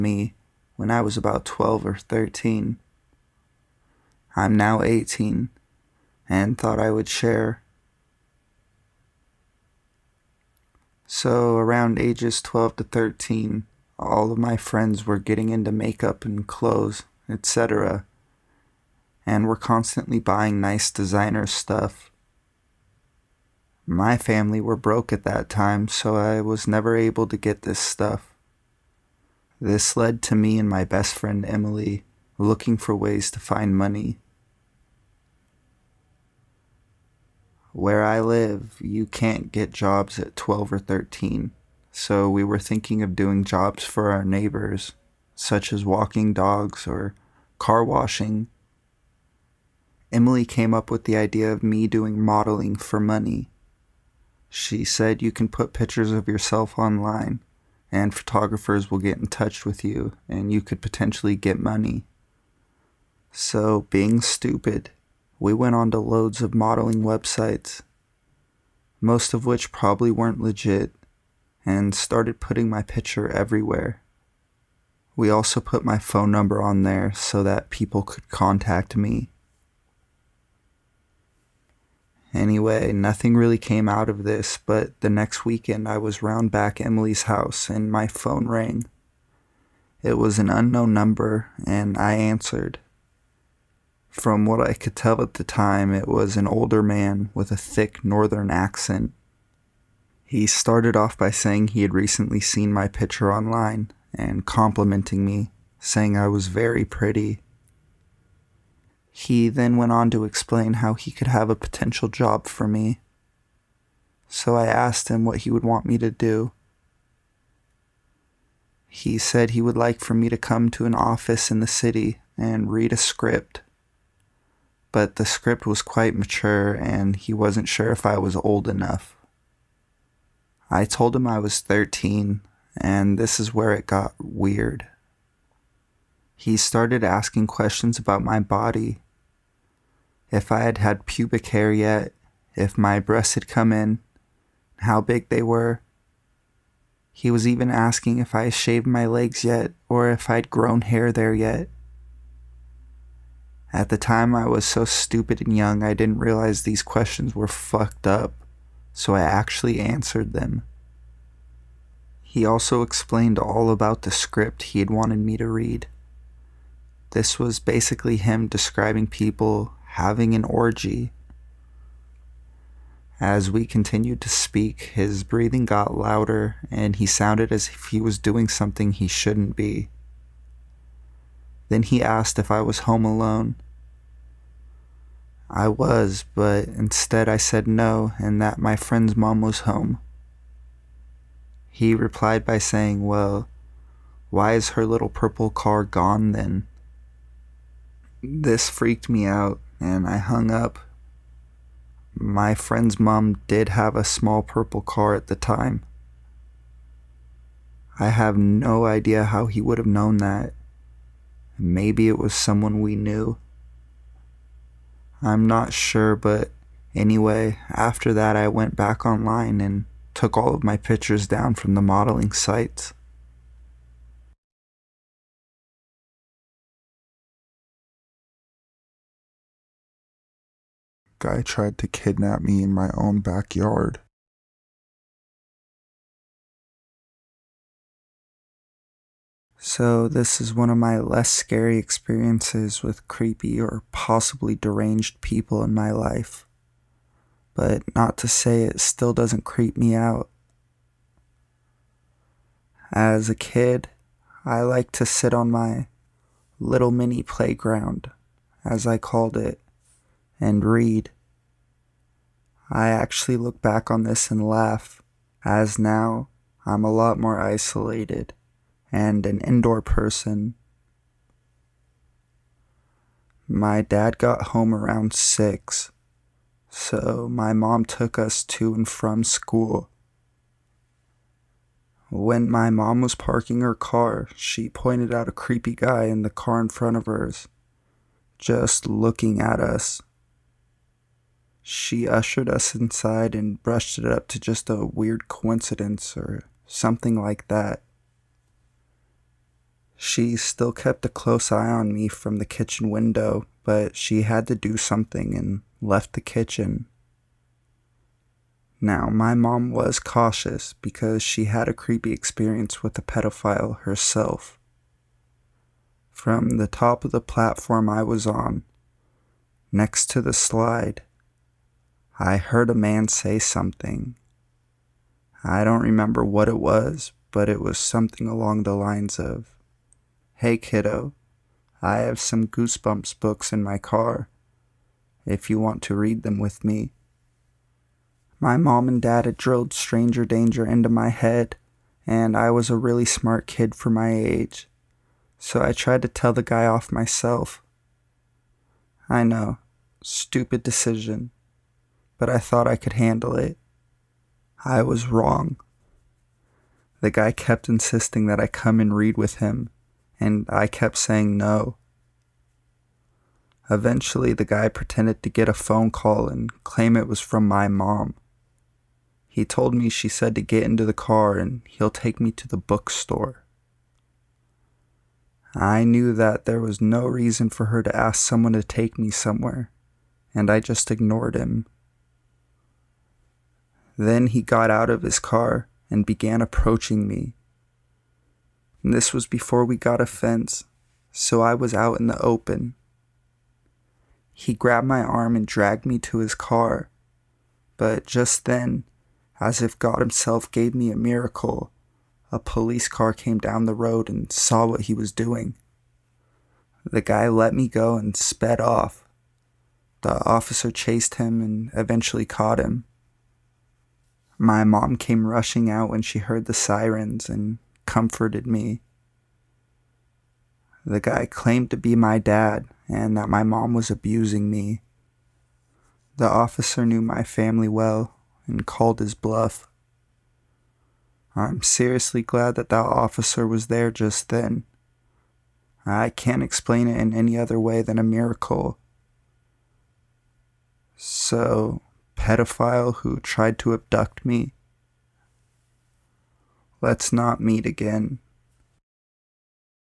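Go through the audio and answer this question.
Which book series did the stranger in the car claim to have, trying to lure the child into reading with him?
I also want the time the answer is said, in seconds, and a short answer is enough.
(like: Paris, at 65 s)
Goosebumps, at 332 s.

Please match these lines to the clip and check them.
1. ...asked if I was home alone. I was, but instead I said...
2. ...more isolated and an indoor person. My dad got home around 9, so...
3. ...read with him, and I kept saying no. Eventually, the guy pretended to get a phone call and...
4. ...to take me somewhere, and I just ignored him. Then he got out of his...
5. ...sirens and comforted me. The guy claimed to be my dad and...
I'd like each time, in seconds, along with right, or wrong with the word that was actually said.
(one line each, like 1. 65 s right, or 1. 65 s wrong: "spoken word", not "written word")
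1. 182 s right
2. 267 s wrong: "6", not "9"
3. 358 s right
4. 378 s right
5. 416 s right.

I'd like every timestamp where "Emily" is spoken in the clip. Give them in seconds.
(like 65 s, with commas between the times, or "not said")
31 s, 50 s, 86 s.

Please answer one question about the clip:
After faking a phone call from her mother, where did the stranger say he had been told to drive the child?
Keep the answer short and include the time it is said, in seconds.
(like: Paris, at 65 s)
The bookstore, at 372 s.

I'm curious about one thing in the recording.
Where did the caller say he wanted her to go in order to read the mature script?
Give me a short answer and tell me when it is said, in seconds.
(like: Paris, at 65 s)
An office in the city, at 121 s.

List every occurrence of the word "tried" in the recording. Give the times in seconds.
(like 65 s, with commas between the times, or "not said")
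231 s, 345 s, 443 s.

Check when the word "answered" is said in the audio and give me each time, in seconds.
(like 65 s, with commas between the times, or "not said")
92 s, 159 s.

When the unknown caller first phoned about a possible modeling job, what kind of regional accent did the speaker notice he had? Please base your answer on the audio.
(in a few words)
Thick northern accent.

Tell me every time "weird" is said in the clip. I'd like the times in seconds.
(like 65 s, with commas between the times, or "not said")
134 s, 294 s.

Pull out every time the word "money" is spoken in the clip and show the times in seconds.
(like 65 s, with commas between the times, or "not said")
33 s, 52 s, 61 s.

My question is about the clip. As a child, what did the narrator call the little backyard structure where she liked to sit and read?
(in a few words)
Mini playground.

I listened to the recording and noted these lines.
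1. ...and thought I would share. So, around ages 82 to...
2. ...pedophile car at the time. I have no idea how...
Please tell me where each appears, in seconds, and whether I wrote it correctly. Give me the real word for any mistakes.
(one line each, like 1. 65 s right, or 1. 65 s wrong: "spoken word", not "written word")
1. 6 s wrong: "12", not "82"
2. 204 s wrong: "purple", not "pedophile".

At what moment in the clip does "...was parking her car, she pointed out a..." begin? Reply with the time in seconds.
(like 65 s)
283 s.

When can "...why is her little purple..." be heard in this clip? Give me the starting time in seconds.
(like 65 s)
194 s.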